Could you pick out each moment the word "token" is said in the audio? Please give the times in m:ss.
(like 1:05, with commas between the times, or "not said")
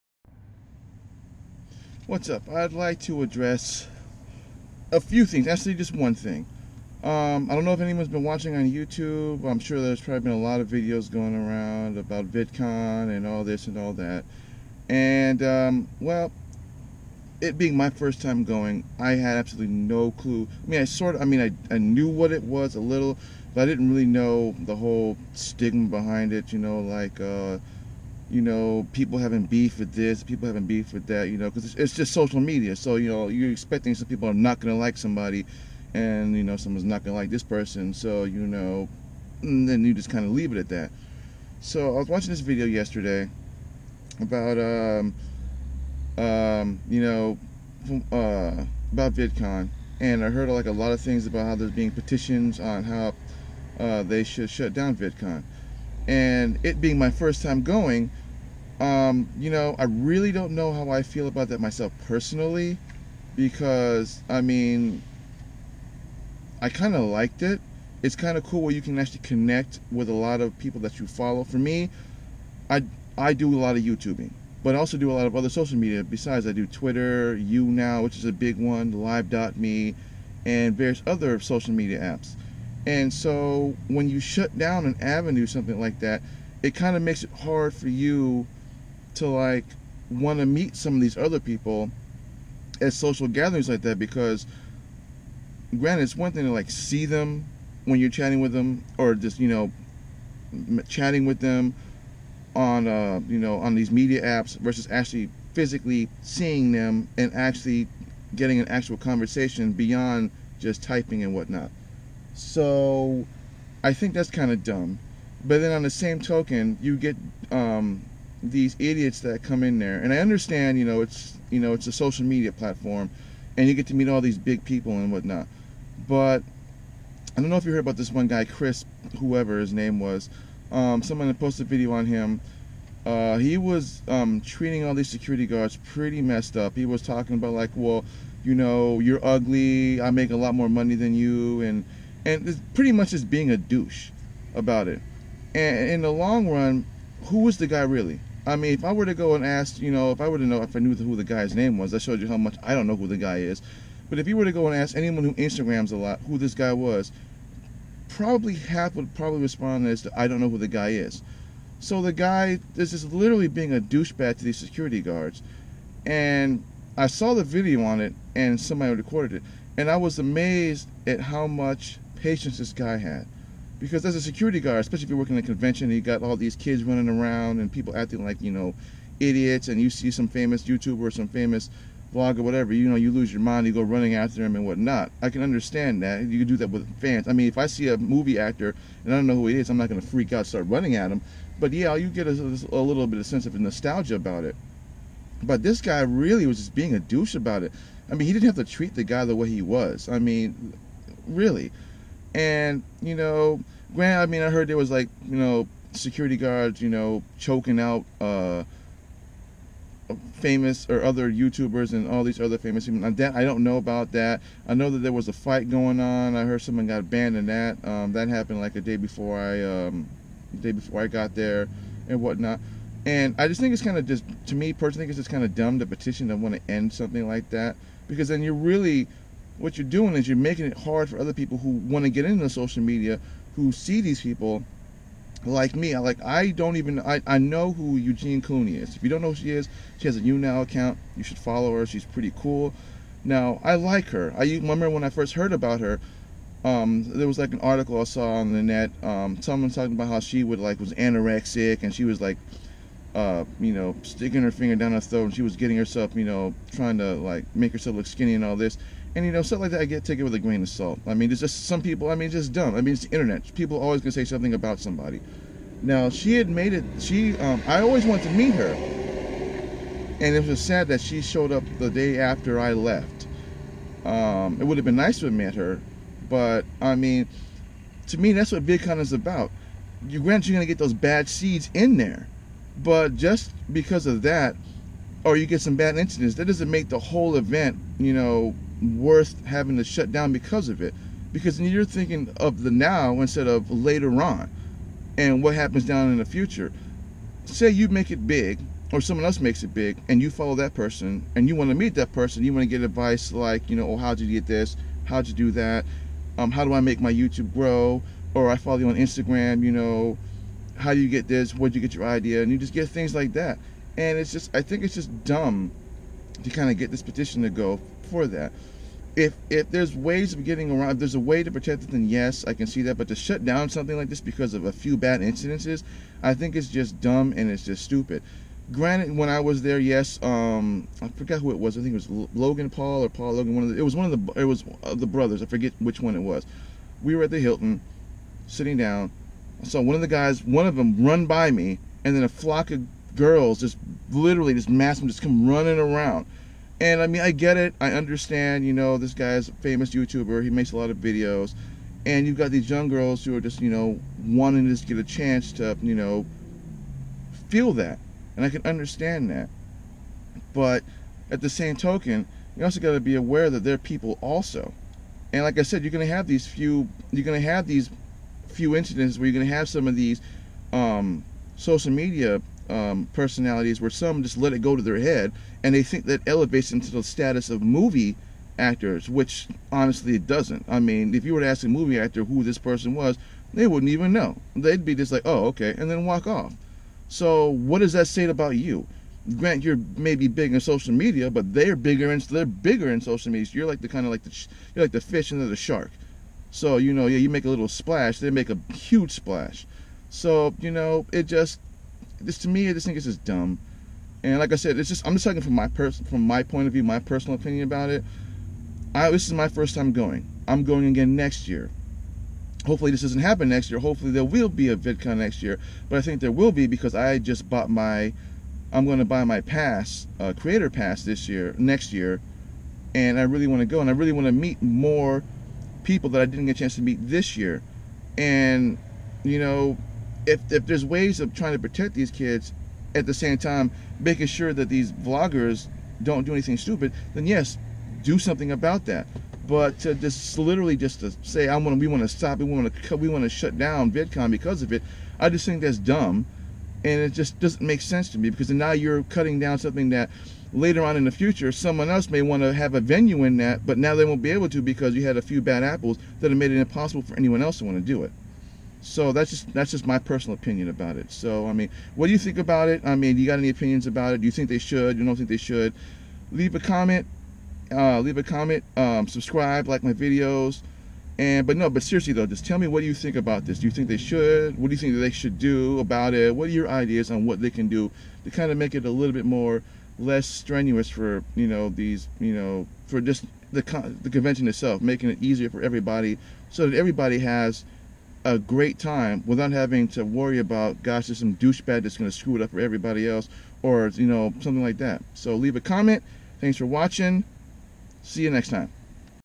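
1:56, 6:01.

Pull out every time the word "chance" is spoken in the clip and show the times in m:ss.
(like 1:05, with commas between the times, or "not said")
5:55, 7:06.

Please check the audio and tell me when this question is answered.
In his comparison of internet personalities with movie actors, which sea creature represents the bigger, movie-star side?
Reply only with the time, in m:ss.
6:35.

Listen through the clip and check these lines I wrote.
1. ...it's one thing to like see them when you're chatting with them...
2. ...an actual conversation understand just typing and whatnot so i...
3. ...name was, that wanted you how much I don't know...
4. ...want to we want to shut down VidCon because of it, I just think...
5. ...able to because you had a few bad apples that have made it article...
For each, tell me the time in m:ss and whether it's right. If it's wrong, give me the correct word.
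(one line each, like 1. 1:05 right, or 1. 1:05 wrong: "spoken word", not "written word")
1. 1:36 right
2. 1:48 wrong: "beyond", not "understand"
3. 2:31 wrong: "showed", not "wanted"
4. 7:22 right
5. 7:34 wrong: "impossible", not "article".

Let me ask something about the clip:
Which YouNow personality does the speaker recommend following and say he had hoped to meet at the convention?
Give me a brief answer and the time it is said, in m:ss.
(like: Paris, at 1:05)
Eugenia Cooney, at 3:57.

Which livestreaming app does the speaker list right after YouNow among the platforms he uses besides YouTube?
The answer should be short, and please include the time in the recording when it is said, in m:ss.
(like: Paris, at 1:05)
Live.me, at 1:18.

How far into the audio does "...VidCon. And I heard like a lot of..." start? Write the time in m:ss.
0:49.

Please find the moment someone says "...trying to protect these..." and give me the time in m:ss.
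7:11.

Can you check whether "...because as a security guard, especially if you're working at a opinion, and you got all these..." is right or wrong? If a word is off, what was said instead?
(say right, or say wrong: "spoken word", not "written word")
wrong: "convention", not "opinion".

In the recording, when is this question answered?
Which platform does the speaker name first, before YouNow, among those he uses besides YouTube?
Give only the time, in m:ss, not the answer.
1:16.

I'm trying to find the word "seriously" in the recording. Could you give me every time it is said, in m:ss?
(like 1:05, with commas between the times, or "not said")
7:51.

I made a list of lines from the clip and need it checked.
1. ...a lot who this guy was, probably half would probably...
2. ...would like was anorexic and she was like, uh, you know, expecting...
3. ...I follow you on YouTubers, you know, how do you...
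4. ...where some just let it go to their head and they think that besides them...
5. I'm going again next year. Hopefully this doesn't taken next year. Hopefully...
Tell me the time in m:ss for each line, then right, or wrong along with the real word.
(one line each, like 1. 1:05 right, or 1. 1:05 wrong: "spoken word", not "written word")
1. 2:35 right
2. 4:10 wrong: "sticking", not "expecting"
3. 5:08 wrong: "Instagram", not "YouTubers"
4. 6:13 wrong: "elevates", not "besides"
5. 6:50 wrong: "happen", not "taken".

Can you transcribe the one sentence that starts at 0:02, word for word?
I'd like to address a few things, actually, just one thing.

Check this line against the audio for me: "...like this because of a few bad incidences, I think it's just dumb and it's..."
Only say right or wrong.
right.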